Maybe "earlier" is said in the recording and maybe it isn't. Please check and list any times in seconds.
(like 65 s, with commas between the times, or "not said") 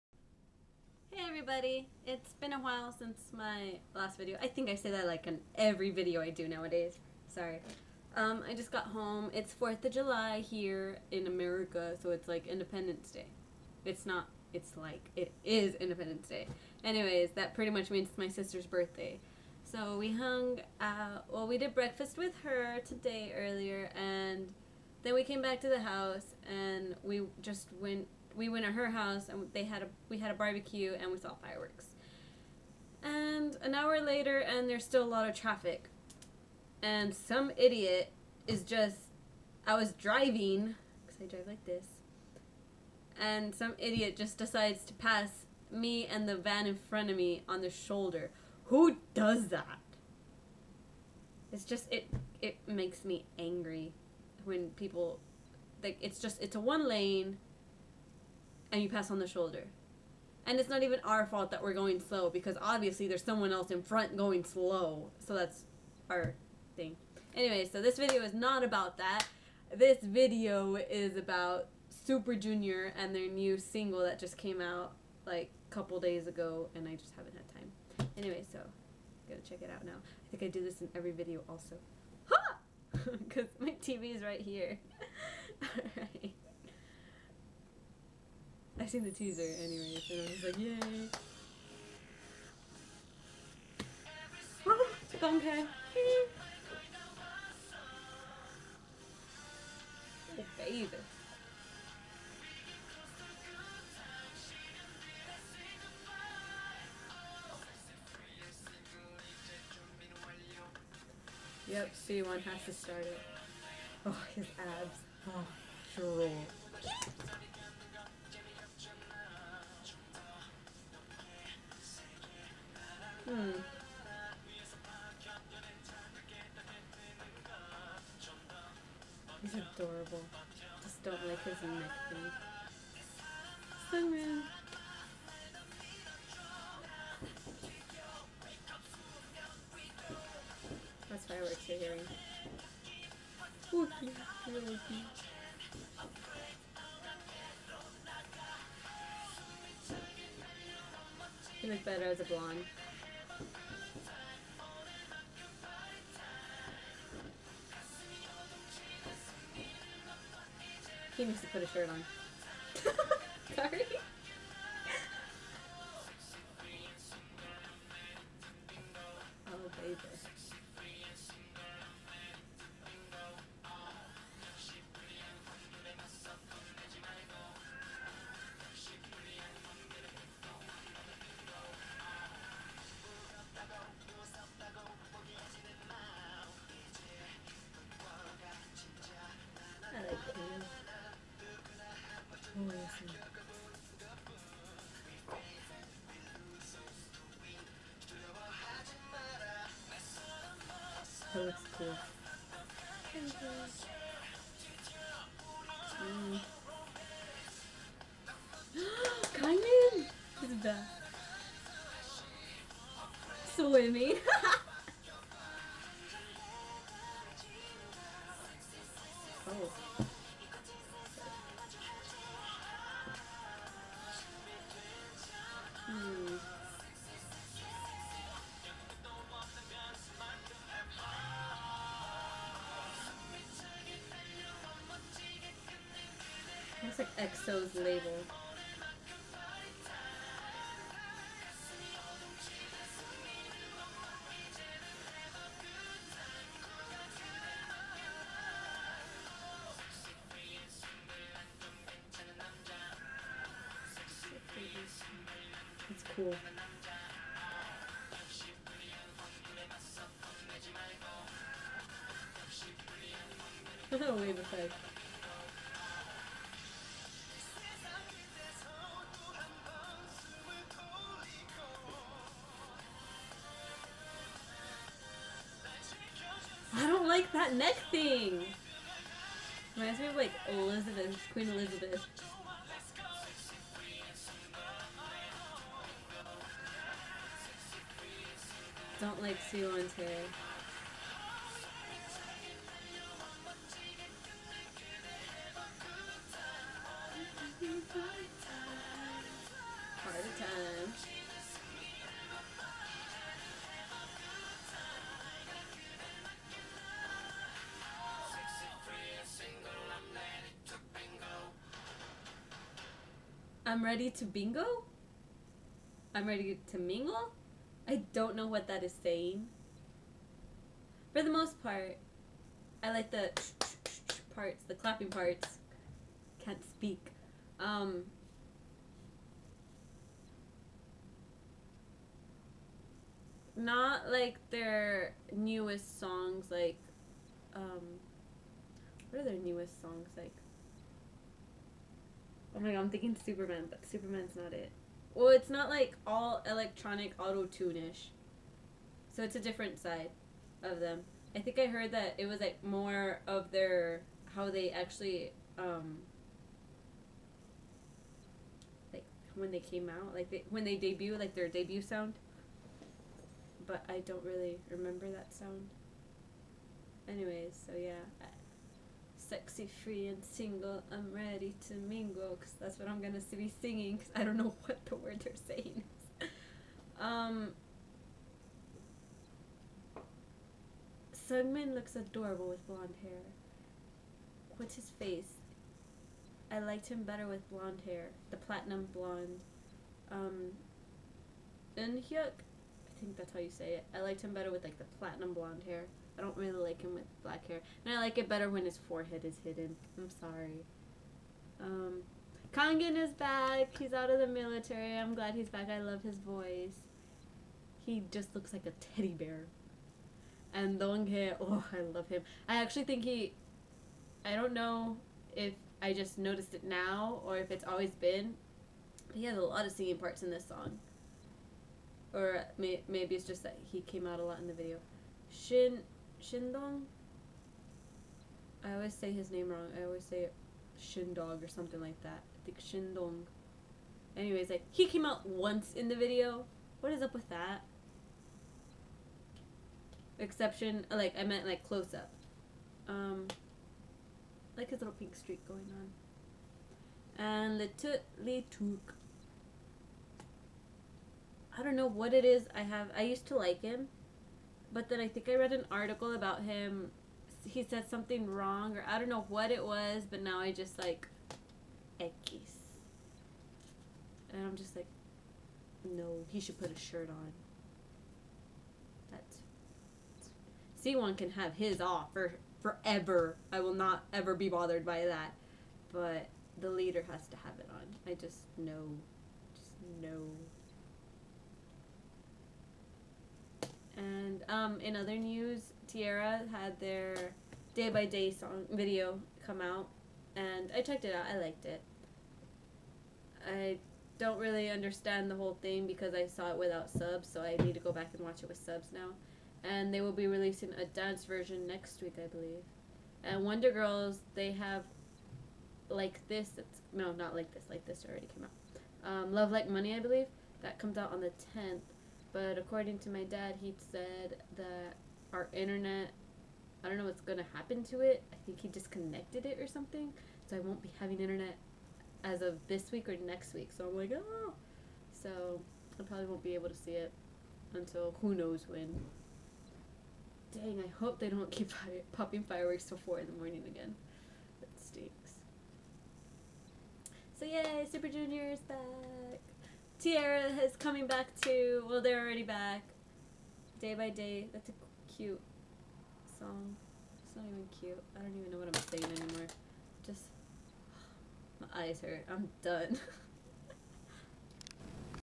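23 s.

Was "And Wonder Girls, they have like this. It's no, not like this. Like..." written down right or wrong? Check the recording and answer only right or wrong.
right.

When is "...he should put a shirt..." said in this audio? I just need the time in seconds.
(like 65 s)
466 s.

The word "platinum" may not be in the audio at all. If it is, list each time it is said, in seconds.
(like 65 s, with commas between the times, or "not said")
388 s, 394 s.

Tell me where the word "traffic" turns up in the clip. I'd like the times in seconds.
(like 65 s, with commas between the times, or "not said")
35 s.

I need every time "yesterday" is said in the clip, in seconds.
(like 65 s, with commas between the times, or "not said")
not said.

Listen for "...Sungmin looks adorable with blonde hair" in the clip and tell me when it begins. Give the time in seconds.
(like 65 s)
381 s.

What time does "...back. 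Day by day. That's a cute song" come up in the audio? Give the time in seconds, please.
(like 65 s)
542 s.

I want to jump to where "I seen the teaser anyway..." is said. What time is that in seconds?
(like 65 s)
88 s.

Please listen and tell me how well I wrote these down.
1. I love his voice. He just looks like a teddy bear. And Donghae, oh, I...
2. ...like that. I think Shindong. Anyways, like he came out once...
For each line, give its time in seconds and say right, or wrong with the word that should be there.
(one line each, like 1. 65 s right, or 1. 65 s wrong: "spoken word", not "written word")
1. 405 s right
2. 431 s right.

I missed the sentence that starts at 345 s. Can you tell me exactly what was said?
Well, it's not like all electronic auto tune-ish.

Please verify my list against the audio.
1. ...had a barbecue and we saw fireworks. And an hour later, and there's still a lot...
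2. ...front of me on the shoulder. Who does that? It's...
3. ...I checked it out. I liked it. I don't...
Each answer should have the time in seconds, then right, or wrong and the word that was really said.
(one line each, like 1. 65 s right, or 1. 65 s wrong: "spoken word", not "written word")
1. 30 s right
2. 46 s right
3. 490 s right.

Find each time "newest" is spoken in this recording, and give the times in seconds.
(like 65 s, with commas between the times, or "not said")
335 s, 339 s.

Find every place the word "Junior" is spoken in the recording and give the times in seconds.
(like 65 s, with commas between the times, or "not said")
72 s, 538 s.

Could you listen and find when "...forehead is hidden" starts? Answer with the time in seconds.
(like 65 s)
398 s.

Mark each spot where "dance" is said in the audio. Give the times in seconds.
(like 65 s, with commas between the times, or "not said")
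500 s.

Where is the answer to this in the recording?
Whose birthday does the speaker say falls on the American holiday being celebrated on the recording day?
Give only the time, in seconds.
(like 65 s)
18 s.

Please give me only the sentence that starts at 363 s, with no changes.
But I don't really remember that sound.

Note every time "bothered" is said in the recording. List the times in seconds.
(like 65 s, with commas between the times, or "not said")
474 s.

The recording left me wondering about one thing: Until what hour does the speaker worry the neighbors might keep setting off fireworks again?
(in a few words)
4 in the morning.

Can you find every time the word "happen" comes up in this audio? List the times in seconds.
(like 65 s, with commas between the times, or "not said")
517 s.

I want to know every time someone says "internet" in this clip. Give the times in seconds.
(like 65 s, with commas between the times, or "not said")
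515 s, 521 s.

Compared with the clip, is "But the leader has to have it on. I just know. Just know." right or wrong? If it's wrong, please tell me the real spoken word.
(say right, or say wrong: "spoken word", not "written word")
right.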